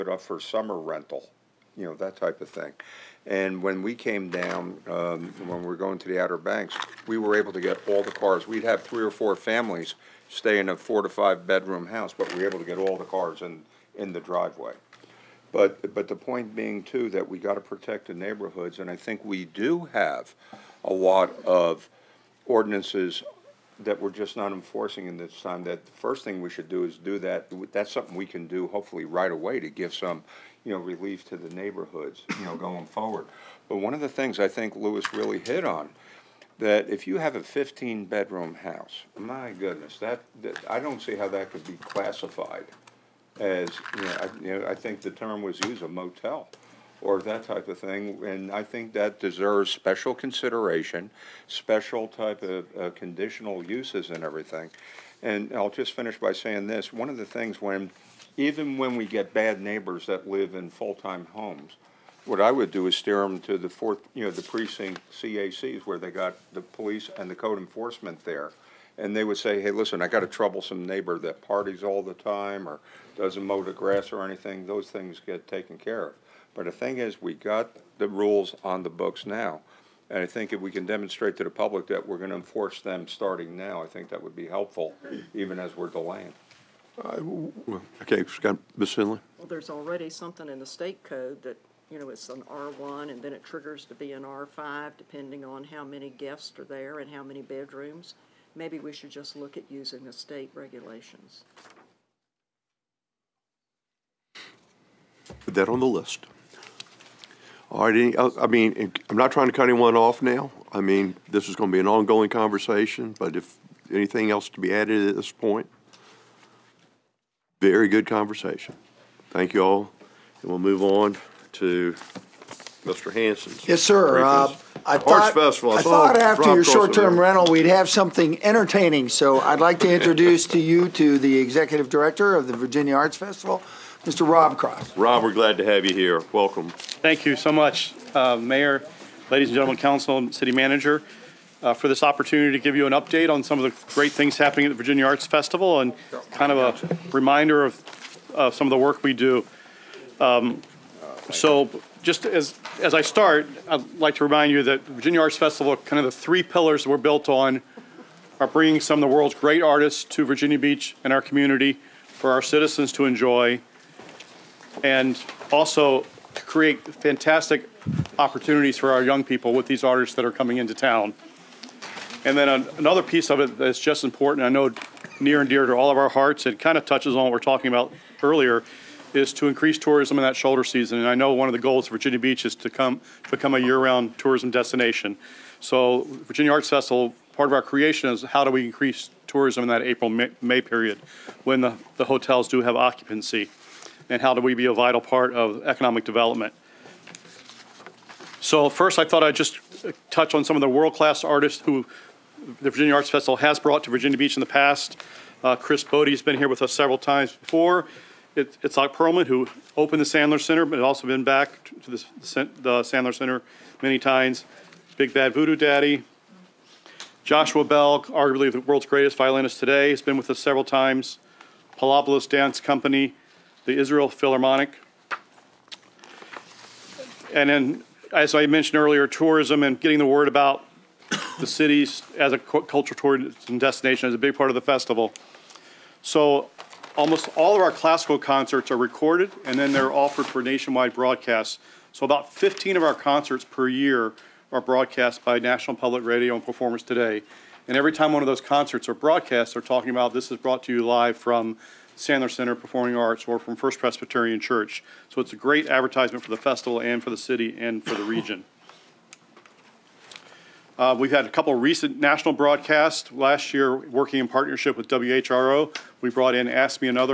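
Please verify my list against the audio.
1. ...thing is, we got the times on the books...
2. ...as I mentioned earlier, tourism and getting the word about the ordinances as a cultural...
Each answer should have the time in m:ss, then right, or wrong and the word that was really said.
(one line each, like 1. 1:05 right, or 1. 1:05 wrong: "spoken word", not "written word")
1. 1:16 wrong: "rules", not "times"
2. 3:48 wrong: "cities", not "ordinances".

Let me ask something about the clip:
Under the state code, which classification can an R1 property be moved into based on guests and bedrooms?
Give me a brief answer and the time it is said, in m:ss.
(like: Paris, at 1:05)
R5, at 1:34.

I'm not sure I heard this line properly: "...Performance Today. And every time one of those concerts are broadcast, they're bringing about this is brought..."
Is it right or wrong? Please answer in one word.
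wrong.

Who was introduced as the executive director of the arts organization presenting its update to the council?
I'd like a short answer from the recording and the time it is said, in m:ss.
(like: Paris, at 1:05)
Rob Cross, at 2:14.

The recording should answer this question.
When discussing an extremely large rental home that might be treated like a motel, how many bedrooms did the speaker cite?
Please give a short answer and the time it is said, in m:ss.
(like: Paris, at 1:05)
15, at 0:37.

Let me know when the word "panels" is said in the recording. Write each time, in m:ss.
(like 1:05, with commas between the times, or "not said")
not said.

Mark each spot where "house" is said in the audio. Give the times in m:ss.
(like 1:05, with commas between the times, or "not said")
0:11, 0:38.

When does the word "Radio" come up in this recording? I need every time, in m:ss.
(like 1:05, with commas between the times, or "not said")
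4:06.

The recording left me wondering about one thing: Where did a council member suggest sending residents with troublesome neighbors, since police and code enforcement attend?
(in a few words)
precinct CACs.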